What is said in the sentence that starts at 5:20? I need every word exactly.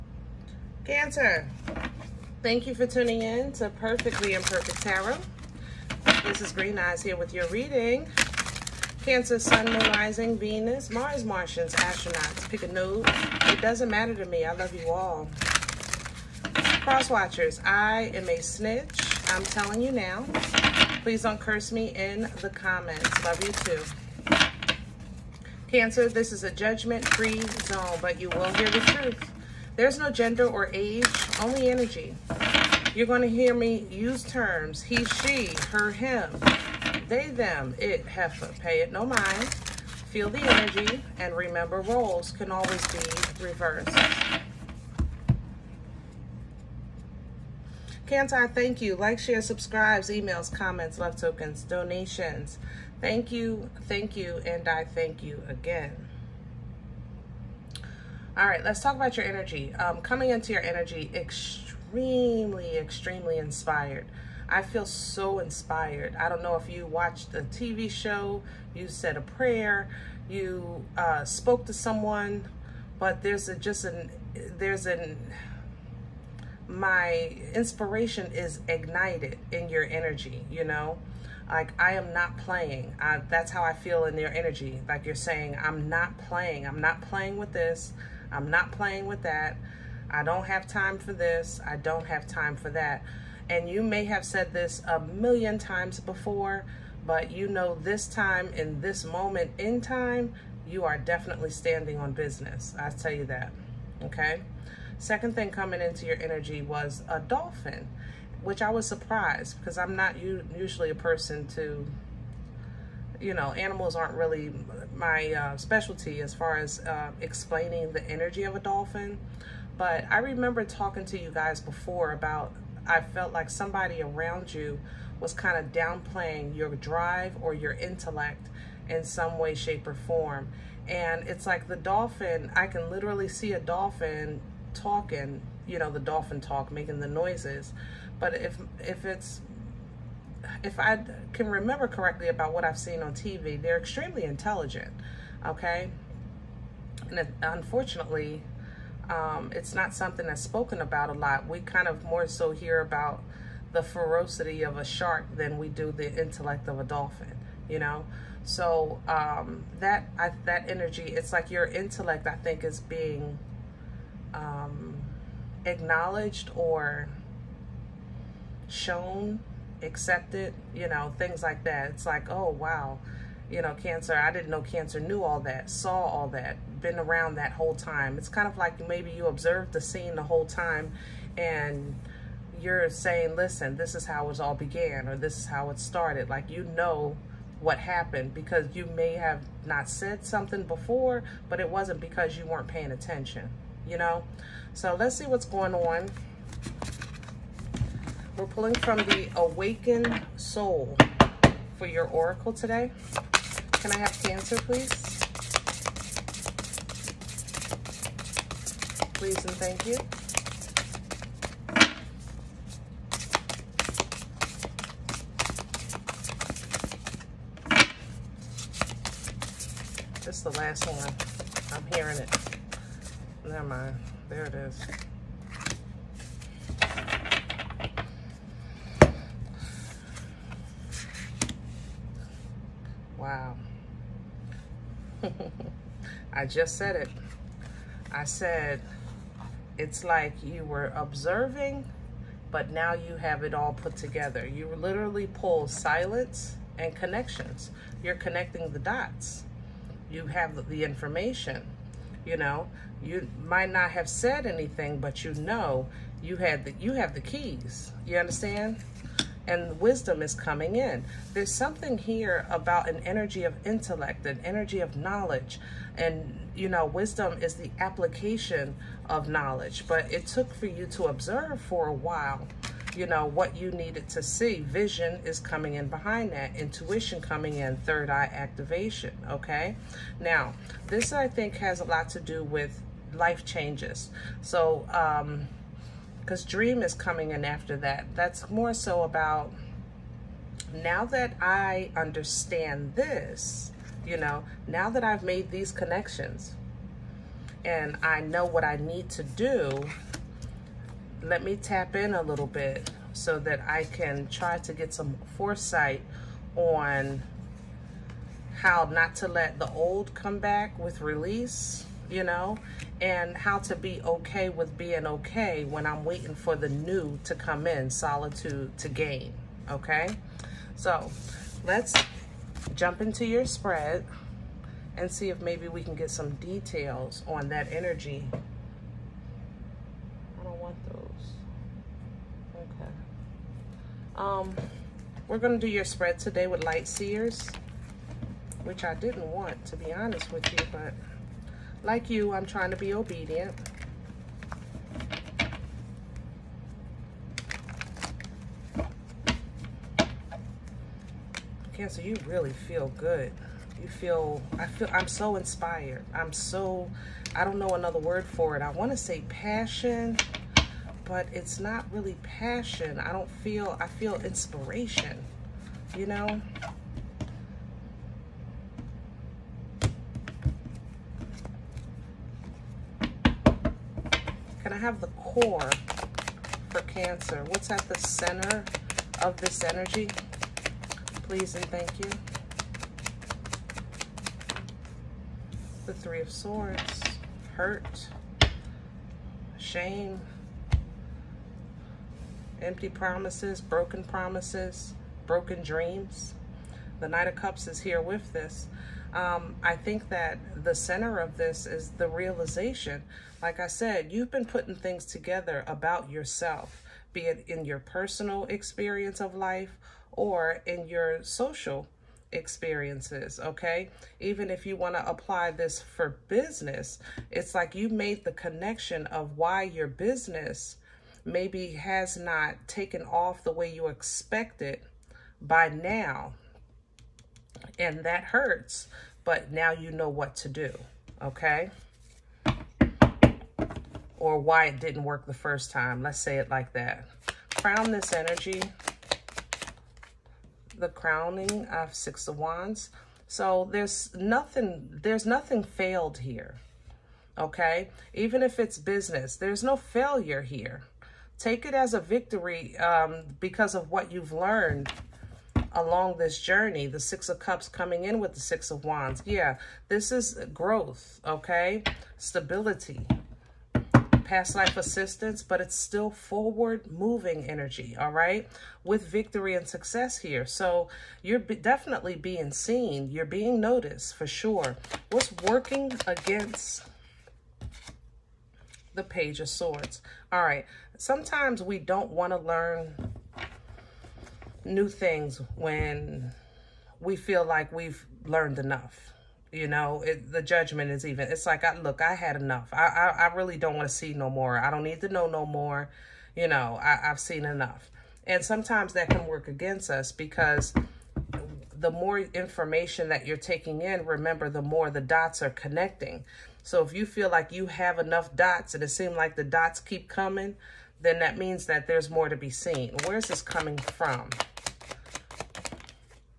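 So let's jump into your spread and see if maybe we can get some details on that energy.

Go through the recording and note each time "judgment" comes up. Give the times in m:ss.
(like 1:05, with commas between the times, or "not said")
0:26, 8:10.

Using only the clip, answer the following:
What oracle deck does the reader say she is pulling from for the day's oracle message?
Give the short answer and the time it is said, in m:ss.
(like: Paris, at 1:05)
The Awakened Soul, at 3:18.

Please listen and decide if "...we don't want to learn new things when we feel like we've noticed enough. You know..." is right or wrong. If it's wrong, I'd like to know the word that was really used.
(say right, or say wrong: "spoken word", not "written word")
wrong: "learned", not "noticed".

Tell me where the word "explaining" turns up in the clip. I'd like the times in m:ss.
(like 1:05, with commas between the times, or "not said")
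1:57.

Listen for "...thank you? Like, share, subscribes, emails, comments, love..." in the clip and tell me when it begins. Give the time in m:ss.
0:48.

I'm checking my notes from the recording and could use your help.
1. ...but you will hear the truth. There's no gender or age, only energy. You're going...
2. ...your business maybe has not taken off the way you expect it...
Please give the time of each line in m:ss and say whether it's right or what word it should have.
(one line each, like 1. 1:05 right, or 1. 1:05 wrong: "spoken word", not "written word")
1. 0:28 right
2. 6:59 right.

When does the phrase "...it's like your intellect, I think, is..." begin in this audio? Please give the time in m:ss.
2:41.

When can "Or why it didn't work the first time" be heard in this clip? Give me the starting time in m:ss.
7:14.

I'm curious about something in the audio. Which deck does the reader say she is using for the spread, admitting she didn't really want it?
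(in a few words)
Light Seers.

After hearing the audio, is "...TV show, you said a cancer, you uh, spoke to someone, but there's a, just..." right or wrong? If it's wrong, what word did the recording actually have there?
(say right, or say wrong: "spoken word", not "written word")
wrong: "prayer", not "cancer".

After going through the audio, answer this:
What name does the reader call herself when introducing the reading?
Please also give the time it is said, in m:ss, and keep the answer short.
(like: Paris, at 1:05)
Green Eyes, at 0:06.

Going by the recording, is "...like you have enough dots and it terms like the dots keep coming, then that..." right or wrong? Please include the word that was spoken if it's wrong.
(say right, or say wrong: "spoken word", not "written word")
wrong: "seems", not "terms".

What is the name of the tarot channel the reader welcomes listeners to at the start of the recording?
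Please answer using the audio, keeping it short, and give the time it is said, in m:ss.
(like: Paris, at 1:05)
Perfectly Imperfect Tarot, at 0:03.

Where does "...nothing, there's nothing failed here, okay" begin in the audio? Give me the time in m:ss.
7:24.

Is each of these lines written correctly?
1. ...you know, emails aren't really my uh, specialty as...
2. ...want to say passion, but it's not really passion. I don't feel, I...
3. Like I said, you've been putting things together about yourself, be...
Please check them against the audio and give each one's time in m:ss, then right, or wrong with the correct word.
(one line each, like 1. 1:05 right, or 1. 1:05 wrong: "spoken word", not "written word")
1. 1:53 wrong: "animals", not "emails"
2. 5:58 right
3. 6:43 right.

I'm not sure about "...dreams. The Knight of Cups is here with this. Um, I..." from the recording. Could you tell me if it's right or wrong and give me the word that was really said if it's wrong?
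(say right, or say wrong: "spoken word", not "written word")
right.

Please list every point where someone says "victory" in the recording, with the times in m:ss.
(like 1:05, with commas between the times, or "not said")
7:31, 7:49.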